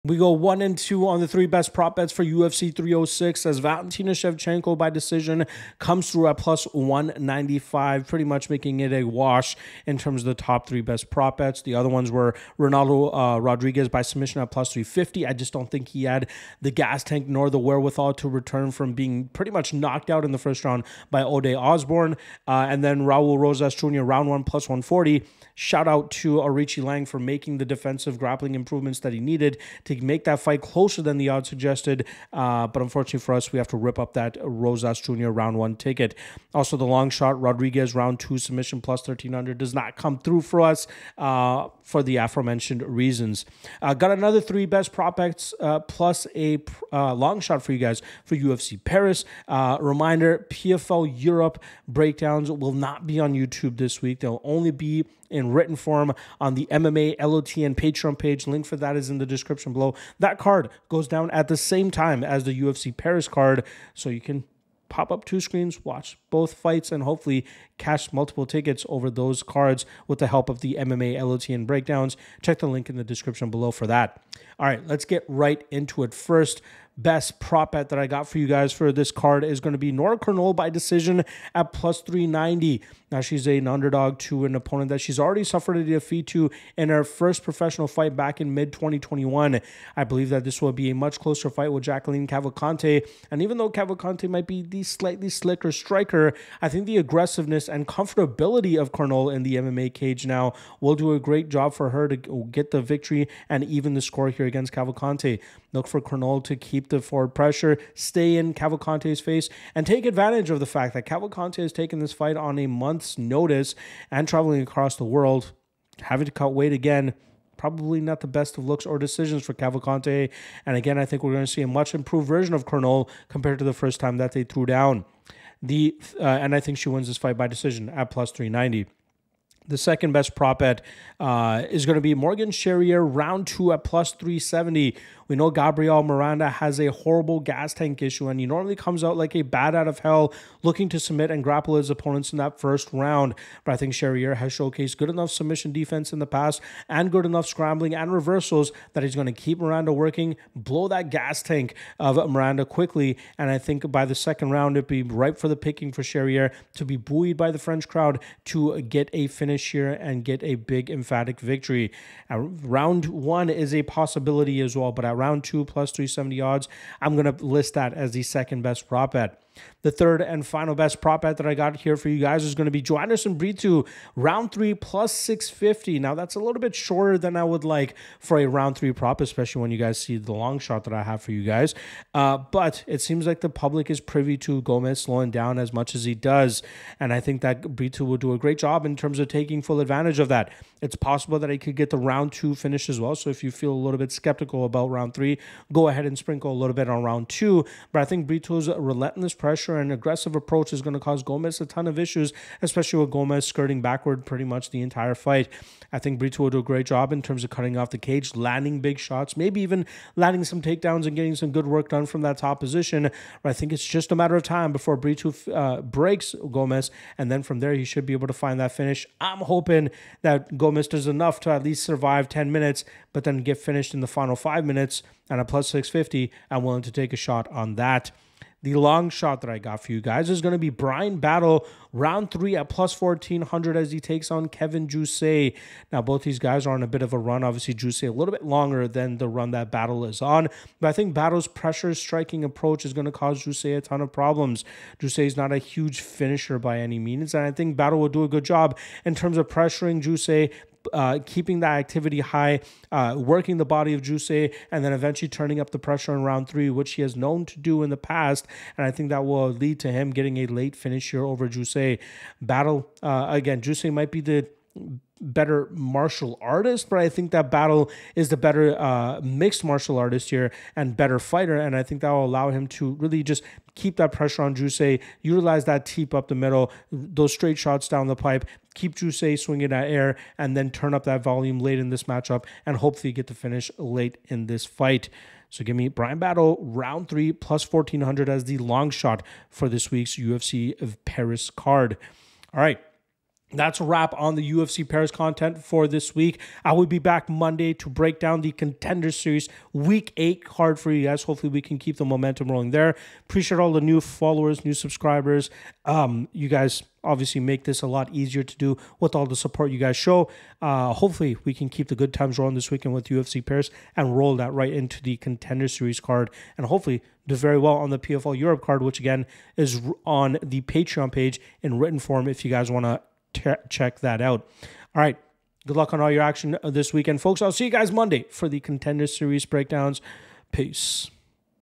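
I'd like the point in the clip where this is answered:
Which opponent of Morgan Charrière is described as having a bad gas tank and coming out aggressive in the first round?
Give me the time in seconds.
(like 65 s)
135 s.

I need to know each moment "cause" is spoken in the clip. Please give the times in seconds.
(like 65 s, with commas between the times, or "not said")
200 s, 243 s.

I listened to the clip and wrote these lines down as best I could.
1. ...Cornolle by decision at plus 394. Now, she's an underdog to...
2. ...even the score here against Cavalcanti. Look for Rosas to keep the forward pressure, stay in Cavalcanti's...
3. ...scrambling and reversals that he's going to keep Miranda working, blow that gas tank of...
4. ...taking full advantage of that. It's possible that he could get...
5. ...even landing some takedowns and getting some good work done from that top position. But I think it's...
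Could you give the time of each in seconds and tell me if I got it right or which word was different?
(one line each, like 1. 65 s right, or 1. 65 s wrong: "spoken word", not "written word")
1. 80 s wrong: "390", not "394"
2. 103 s wrong: "Cornolle", not "Rosas"
3. 147 s right
4. 189 s right
5. 209 s right.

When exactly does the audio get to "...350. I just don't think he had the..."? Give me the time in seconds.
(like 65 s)
14 s.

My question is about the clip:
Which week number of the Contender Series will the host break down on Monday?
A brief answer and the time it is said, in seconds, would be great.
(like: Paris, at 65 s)
8, at 299 s.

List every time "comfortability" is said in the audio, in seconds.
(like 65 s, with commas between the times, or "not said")
97 s.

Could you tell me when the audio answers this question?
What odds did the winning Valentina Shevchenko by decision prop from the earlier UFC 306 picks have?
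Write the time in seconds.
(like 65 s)
6 s.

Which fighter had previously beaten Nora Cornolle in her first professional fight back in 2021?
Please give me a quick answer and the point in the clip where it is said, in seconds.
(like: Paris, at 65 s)
Jacqueline Cavalcanti, at 91 s.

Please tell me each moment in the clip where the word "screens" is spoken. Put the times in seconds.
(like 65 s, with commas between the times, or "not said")
65 s.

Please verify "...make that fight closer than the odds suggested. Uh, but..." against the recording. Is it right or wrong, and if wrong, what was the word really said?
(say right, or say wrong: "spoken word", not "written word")
right.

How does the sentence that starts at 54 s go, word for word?
They'll only be in written form on the MMA, LOTN Patreon page.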